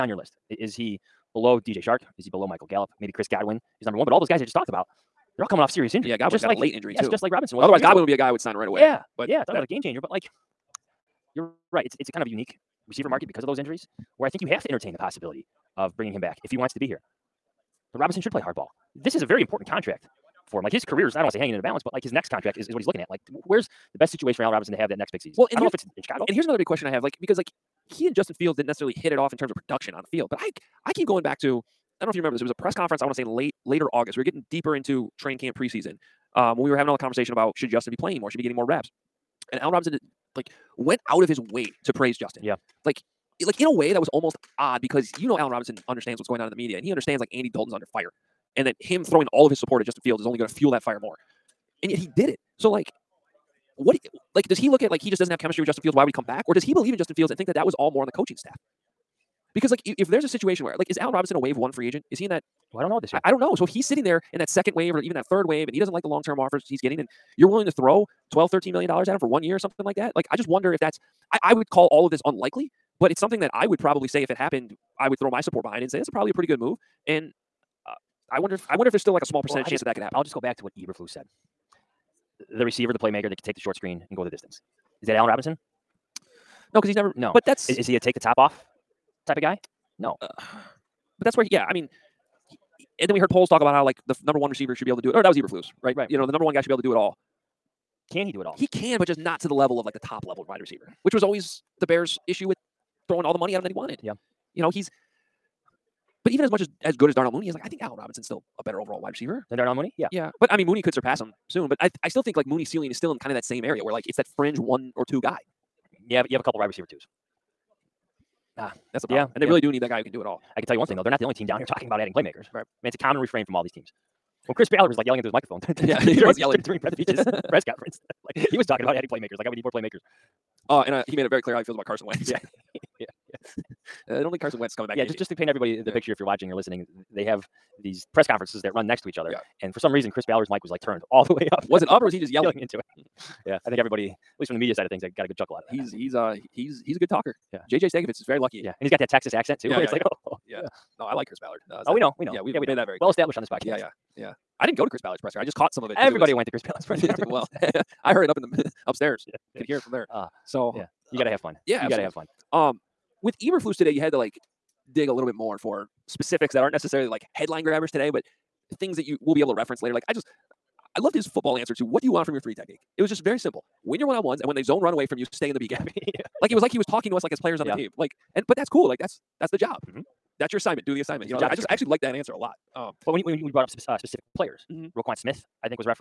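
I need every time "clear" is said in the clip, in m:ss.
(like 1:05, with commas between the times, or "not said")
2:11, 2:32.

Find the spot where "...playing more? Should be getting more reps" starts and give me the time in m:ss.
0:37.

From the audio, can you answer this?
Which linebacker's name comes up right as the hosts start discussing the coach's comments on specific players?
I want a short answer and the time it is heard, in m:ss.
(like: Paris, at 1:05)
Roquan Smith, at 3:04.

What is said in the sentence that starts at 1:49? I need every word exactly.
Yeah, yeah, but I mean Mooney could surpass him soon.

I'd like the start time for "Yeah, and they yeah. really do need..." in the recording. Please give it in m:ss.
1:59.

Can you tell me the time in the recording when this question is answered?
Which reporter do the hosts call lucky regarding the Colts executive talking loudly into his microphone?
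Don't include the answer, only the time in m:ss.
2:27.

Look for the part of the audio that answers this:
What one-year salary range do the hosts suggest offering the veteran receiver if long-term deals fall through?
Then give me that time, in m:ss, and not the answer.
1:08.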